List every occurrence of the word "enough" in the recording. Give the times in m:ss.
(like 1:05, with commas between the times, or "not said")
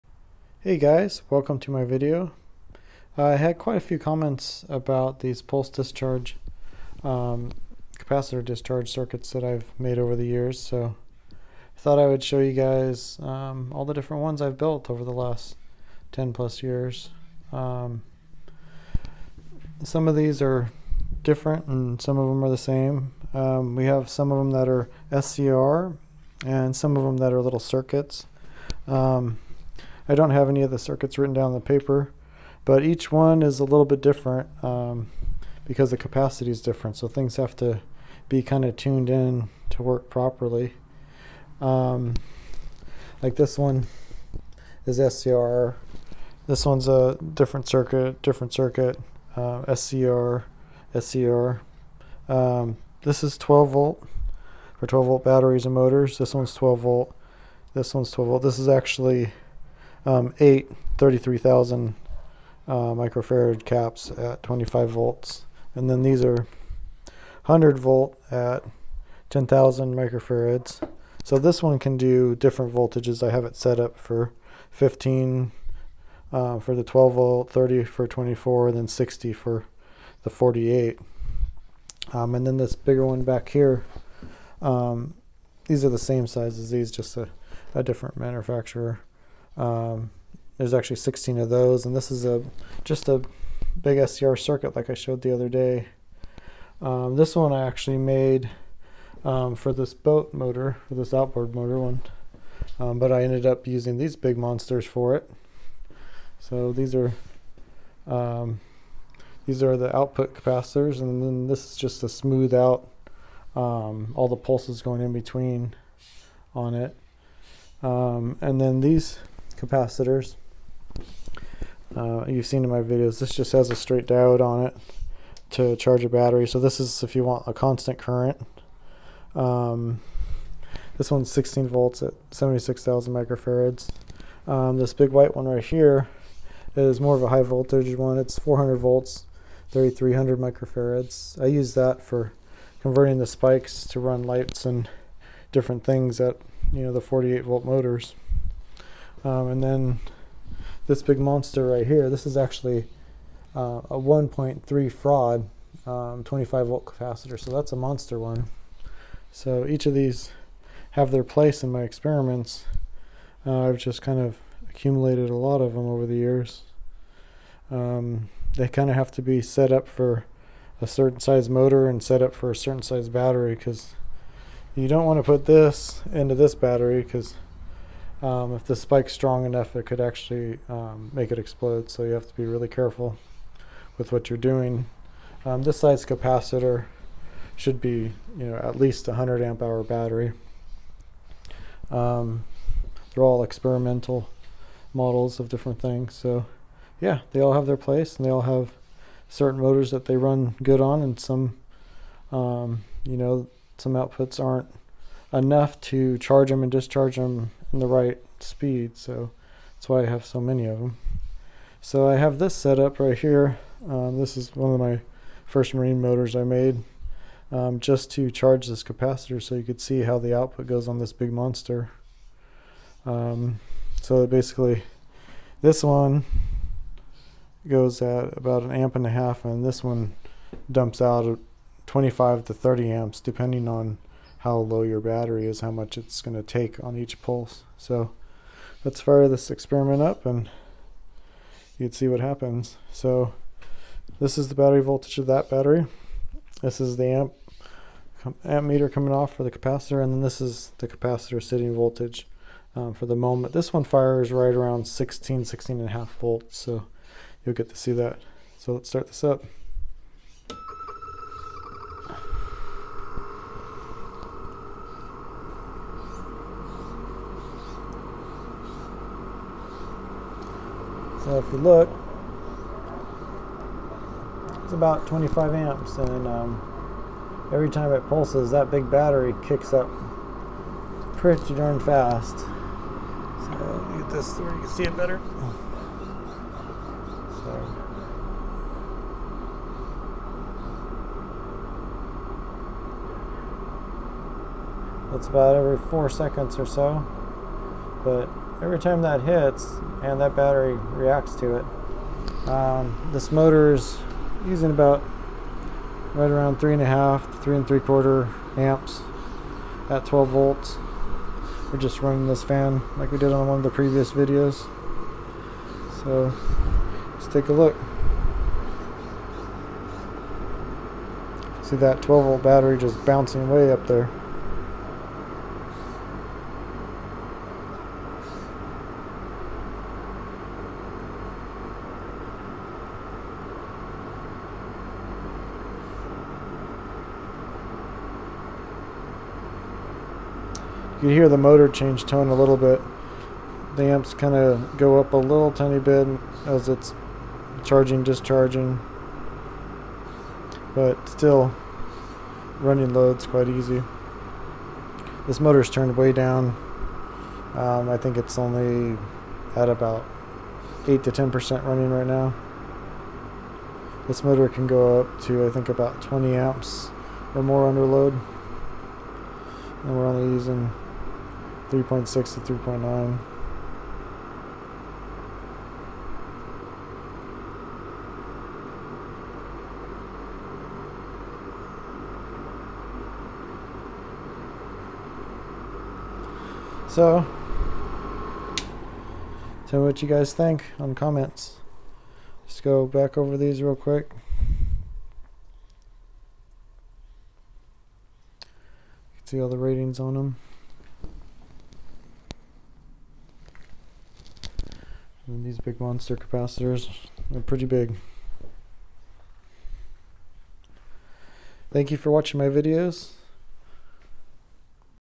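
2:59, 3:25.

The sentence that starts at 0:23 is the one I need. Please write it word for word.
Um, we have some of them that are SCR and some of them that are little circuits.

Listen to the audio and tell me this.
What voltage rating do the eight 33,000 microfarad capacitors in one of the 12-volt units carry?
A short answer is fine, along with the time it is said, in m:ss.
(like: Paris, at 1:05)
25 volts, at 1:04.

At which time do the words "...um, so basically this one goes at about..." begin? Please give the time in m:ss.
3:43.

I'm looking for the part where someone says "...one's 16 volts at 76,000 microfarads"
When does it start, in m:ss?
2:11.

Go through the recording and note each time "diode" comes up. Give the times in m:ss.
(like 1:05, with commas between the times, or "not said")
2:04.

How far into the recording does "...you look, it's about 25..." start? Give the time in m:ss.
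4:31.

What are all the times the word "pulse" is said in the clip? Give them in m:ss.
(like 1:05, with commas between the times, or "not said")
0:05, 1:54, 3:57, 4:38.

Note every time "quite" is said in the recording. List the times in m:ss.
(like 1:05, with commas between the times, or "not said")
0:03, 5:53.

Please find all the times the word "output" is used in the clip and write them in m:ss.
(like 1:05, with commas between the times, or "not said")
1:49, 3:23, 3:40.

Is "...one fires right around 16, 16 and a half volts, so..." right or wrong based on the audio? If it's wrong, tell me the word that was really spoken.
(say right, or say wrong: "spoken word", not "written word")
right.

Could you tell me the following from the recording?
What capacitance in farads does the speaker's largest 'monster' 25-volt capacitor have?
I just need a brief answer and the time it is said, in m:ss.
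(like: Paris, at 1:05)
1.3 farad, at 2:33.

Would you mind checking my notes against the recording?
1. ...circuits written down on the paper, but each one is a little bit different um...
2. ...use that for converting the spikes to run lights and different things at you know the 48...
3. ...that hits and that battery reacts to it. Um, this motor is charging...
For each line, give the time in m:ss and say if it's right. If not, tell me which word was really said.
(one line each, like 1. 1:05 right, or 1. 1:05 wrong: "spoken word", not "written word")
1. 0:30 right
2. 2:21 right
3. 4:59 wrong: "using", not "charging".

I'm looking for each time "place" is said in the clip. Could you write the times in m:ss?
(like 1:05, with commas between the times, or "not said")
2:41, 3:17.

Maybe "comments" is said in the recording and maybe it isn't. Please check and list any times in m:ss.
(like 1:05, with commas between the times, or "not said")
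0:03, 6:30.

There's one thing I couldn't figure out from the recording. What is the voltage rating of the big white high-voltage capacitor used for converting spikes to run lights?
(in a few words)
400 volts.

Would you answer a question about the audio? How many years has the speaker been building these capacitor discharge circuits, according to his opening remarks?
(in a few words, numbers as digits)
10 plus years.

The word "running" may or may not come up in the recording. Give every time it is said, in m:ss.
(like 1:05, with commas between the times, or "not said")
5:12, 5:52, 6:01.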